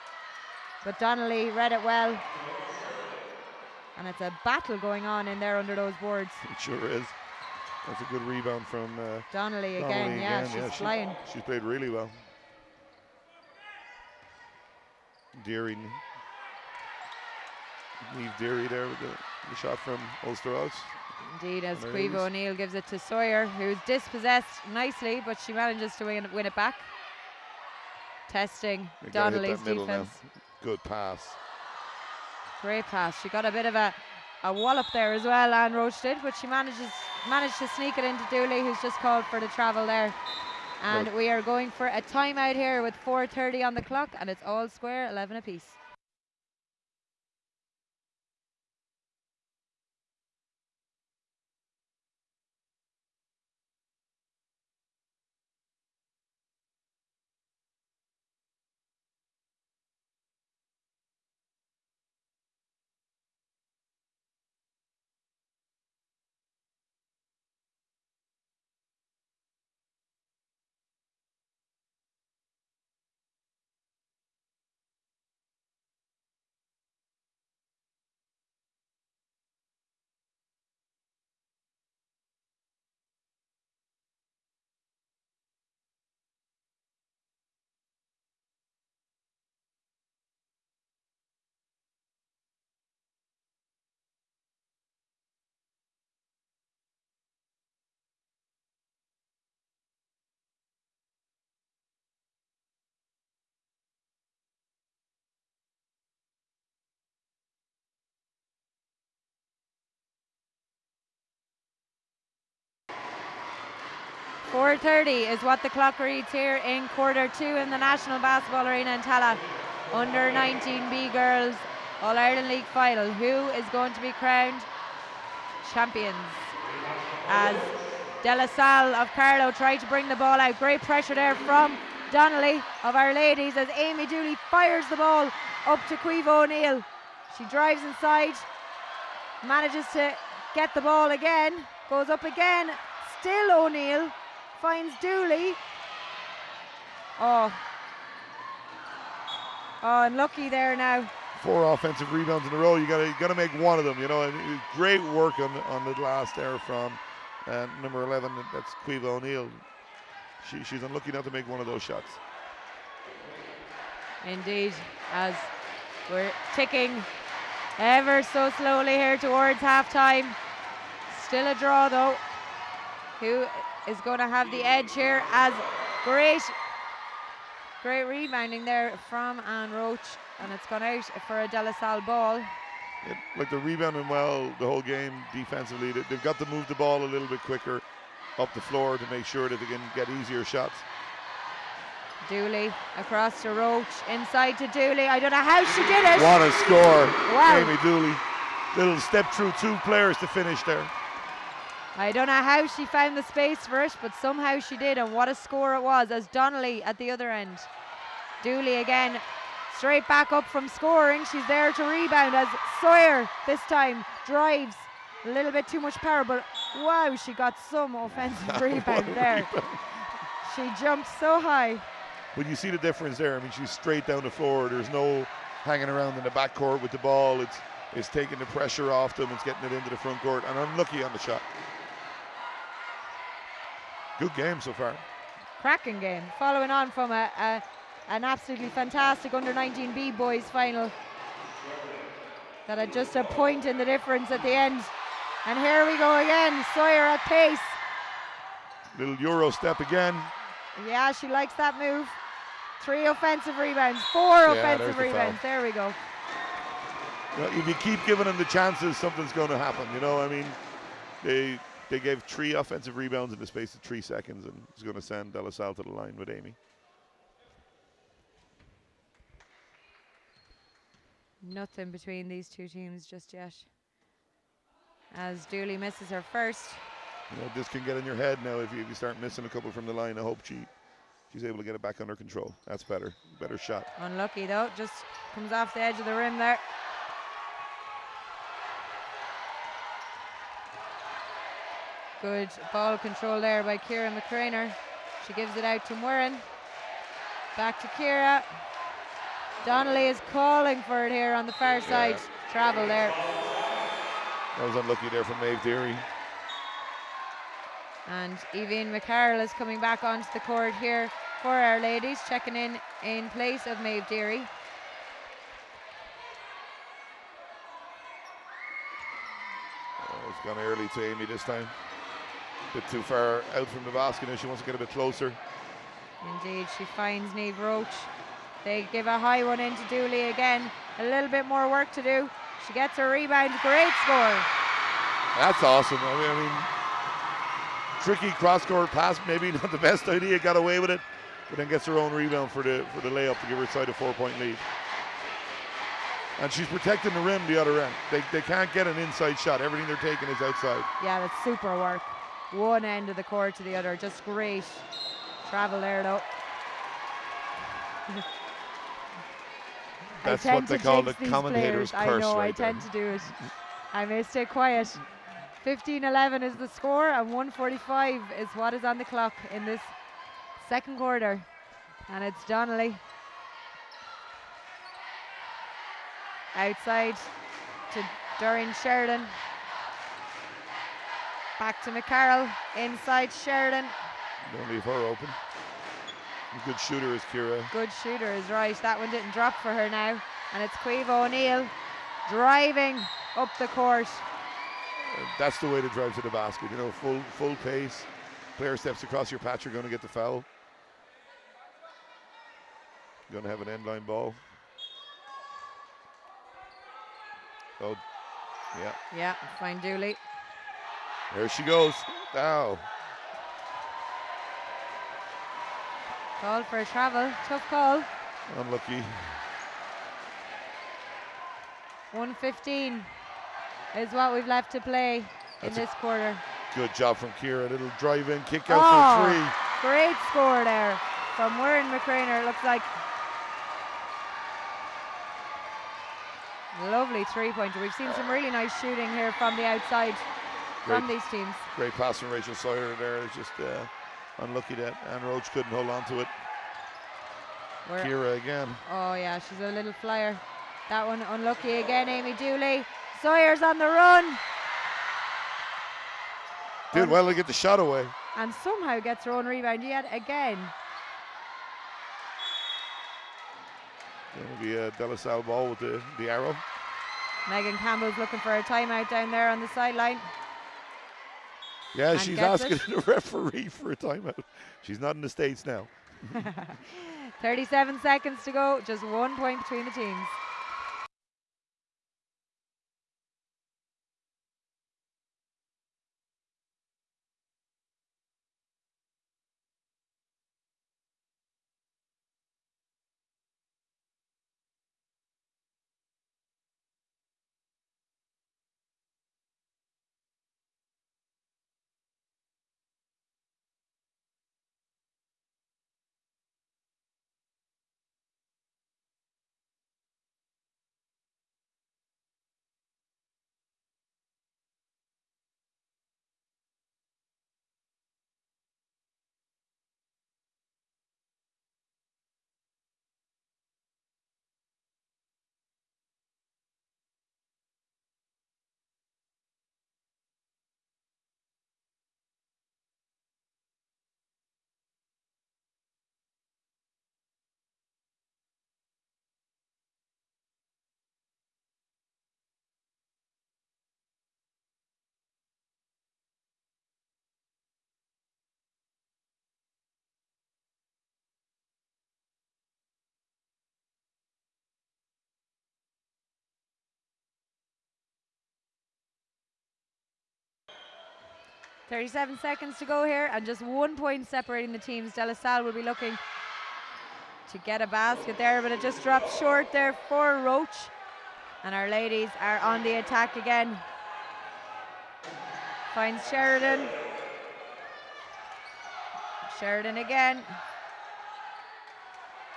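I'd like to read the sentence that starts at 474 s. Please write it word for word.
She's not in the States now.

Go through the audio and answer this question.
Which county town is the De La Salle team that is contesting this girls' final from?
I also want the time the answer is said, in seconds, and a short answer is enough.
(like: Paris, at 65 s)
Carlow, at 129 s.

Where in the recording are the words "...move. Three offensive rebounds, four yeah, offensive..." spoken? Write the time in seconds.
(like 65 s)
251 s.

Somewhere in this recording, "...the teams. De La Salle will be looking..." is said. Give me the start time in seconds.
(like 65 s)
564 s.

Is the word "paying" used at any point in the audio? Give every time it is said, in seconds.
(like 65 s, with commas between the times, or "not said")
not said.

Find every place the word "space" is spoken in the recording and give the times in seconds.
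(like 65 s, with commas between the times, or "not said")
203 s, 263 s.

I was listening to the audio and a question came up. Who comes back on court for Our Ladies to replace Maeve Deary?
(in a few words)
Evine McCarroll.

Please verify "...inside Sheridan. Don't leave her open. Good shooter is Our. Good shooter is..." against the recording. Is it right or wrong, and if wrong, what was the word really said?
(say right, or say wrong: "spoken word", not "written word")
wrong: "Kira", not "Our".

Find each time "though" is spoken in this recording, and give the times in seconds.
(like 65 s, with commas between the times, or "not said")
171 s, 284 s, 356 s.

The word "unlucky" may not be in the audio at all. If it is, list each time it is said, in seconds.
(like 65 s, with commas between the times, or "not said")
150 s, 160 s, 230 s, 283 s, 304 s, 418 s, 444 s, 451 s.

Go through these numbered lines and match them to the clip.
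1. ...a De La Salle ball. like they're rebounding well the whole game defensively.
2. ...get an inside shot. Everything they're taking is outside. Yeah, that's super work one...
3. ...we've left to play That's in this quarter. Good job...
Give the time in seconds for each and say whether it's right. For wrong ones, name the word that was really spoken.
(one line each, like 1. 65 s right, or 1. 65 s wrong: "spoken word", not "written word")
1. 181 s right
2. 348 s right
3. 424 s right.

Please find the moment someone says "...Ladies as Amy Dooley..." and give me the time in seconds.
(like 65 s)
133 s.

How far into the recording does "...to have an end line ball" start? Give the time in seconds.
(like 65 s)
403 s.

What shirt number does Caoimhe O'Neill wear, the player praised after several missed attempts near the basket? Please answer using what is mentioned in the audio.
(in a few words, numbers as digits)
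11.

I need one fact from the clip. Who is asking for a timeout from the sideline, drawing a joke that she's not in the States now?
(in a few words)
Megan Campbell.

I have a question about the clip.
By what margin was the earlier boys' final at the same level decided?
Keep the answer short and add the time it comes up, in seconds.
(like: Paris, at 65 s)
1 point, at 243 s.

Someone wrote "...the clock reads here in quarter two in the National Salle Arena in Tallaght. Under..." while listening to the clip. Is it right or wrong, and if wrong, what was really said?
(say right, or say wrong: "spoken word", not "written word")
wrong: "Basketball", not "Salle".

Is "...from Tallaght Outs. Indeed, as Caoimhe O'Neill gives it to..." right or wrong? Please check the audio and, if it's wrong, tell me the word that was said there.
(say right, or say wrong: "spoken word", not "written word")
wrong: "Ulster", not "Tallaght".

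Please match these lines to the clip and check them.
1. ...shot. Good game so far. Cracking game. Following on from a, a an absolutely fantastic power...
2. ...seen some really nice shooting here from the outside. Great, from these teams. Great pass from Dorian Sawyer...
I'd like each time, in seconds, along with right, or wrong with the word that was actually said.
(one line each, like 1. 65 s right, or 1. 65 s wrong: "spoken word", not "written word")
1. 231 s wrong: "under", not "power"
2. 437 s wrong: "Rachel", not "Dorian".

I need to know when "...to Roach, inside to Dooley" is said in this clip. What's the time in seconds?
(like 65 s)
193 s.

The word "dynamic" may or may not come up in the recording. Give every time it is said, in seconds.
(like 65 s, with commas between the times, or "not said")
not said.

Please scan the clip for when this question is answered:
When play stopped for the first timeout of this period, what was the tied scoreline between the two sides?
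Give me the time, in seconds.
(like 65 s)
45 s.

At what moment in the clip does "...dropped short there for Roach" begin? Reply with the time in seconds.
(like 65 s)
569 s.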